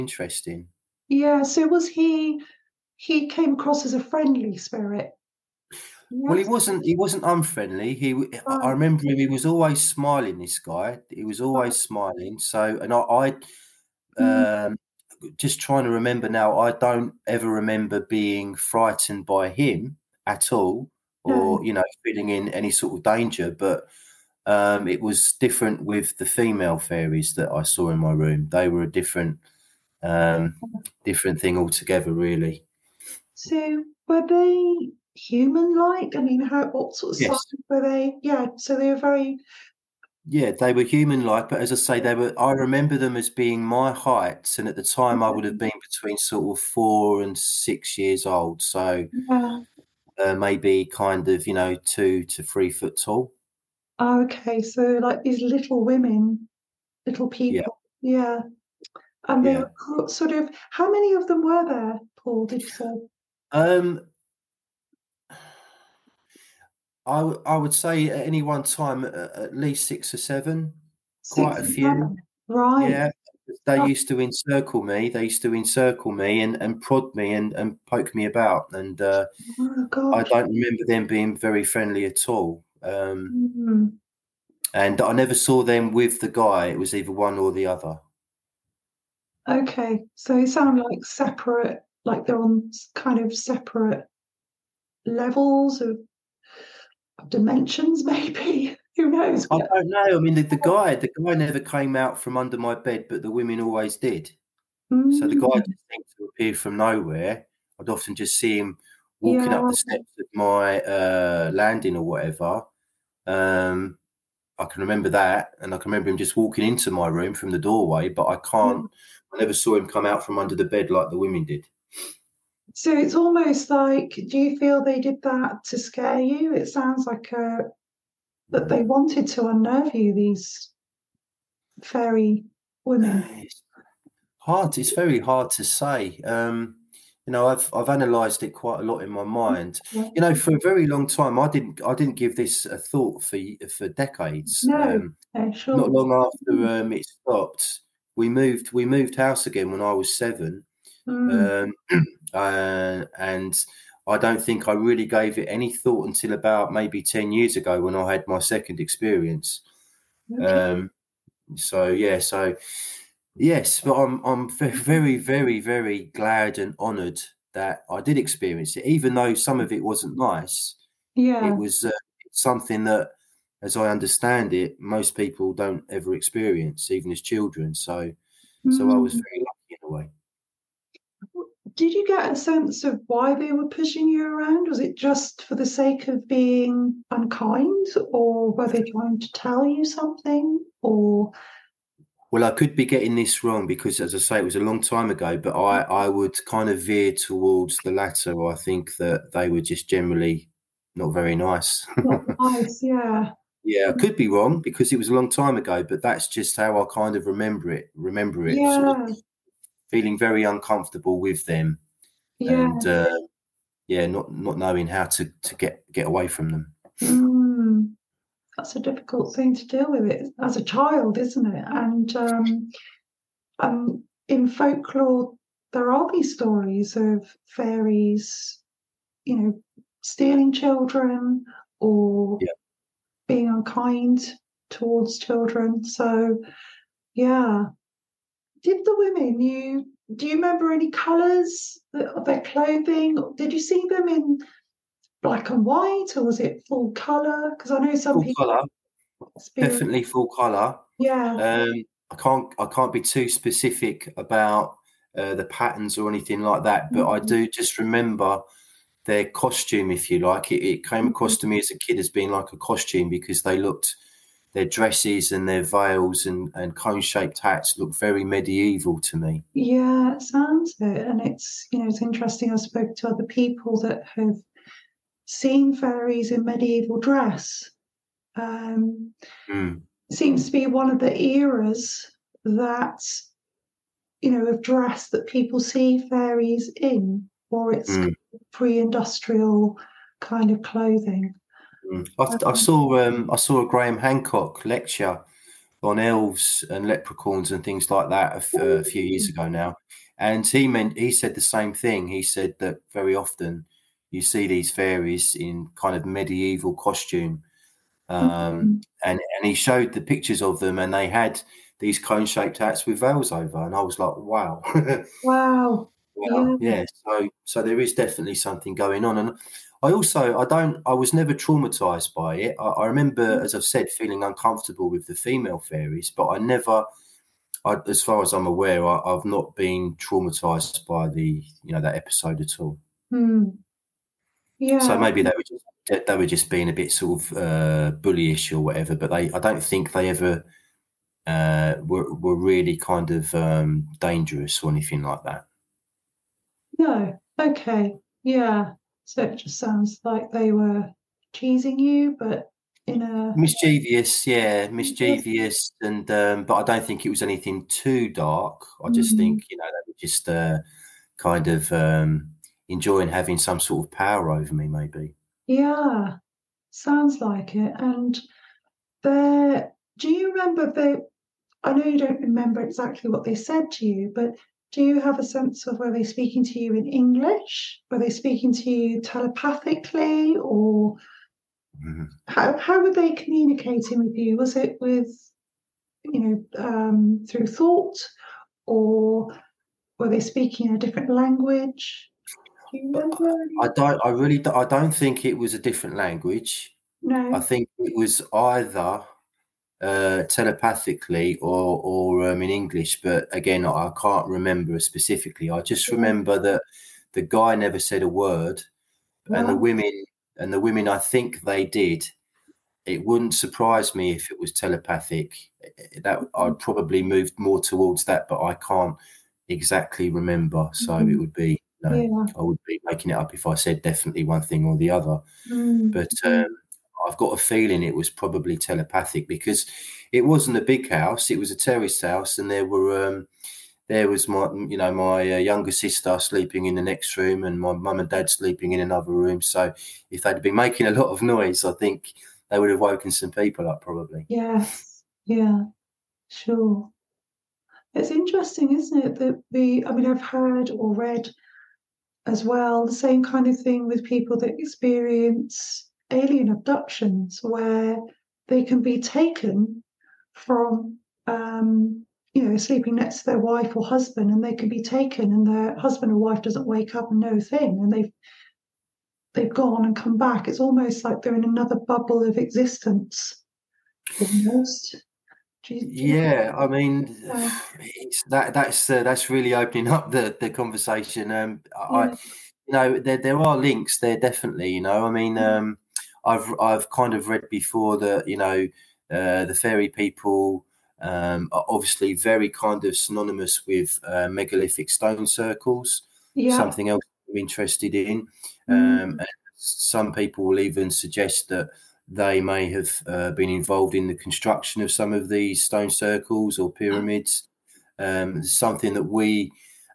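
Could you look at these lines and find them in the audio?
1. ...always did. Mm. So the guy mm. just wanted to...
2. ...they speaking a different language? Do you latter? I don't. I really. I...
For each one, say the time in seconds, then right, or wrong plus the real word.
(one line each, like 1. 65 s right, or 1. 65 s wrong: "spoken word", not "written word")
1. 103 s wrong: "seemed", not "wanted"
2. 390 s wrong: "remember", not "latter".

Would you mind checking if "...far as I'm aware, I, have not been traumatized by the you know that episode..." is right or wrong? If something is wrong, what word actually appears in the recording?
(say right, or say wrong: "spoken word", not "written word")
right.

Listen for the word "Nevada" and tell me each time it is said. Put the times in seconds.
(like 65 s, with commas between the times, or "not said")
not said.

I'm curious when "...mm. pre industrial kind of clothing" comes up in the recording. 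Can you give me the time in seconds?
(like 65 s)
287 s.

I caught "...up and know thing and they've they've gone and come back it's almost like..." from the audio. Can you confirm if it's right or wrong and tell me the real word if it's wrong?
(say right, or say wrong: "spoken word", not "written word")
right.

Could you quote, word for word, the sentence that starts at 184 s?
Was it just for the sake of being unkind, or were they trying to tell you something?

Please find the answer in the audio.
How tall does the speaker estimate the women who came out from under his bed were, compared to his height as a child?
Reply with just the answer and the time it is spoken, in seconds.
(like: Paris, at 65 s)
2 to 3 feet, at 51 s.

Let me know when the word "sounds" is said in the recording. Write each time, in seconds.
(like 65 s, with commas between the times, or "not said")
90 s, 126 s, 270 s, 349 s, 366 s.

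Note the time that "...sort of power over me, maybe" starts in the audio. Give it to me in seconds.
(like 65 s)
363 s.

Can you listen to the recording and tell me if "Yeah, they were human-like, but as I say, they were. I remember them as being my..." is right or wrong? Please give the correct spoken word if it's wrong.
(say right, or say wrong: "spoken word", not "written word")
right.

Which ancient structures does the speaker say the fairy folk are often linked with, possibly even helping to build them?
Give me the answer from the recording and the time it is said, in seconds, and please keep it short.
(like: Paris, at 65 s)
Megalithic stone circles, at 494 s.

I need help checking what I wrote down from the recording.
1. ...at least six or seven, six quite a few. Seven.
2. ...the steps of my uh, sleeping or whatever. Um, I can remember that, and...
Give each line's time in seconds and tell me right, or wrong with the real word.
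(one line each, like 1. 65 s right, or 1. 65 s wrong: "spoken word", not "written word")
1. 69 s right
2. 109 s wrong: "landing", not "sleeping".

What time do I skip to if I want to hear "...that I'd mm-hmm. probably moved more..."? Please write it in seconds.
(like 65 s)
416 s.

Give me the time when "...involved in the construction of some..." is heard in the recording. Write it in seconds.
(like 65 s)
503 s.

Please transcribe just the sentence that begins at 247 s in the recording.
Because I know some full people colour.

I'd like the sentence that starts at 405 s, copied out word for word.
I just remember that the guy never said a word, no.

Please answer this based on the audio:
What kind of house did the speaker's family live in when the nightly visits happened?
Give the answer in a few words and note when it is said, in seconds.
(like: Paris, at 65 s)
Terraced house, at 431 s.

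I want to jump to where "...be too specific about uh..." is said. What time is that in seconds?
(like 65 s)
252 s.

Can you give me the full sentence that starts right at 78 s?
And uh, oh I don't remember them being very friendly at all.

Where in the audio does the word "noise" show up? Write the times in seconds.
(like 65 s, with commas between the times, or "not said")
441 s.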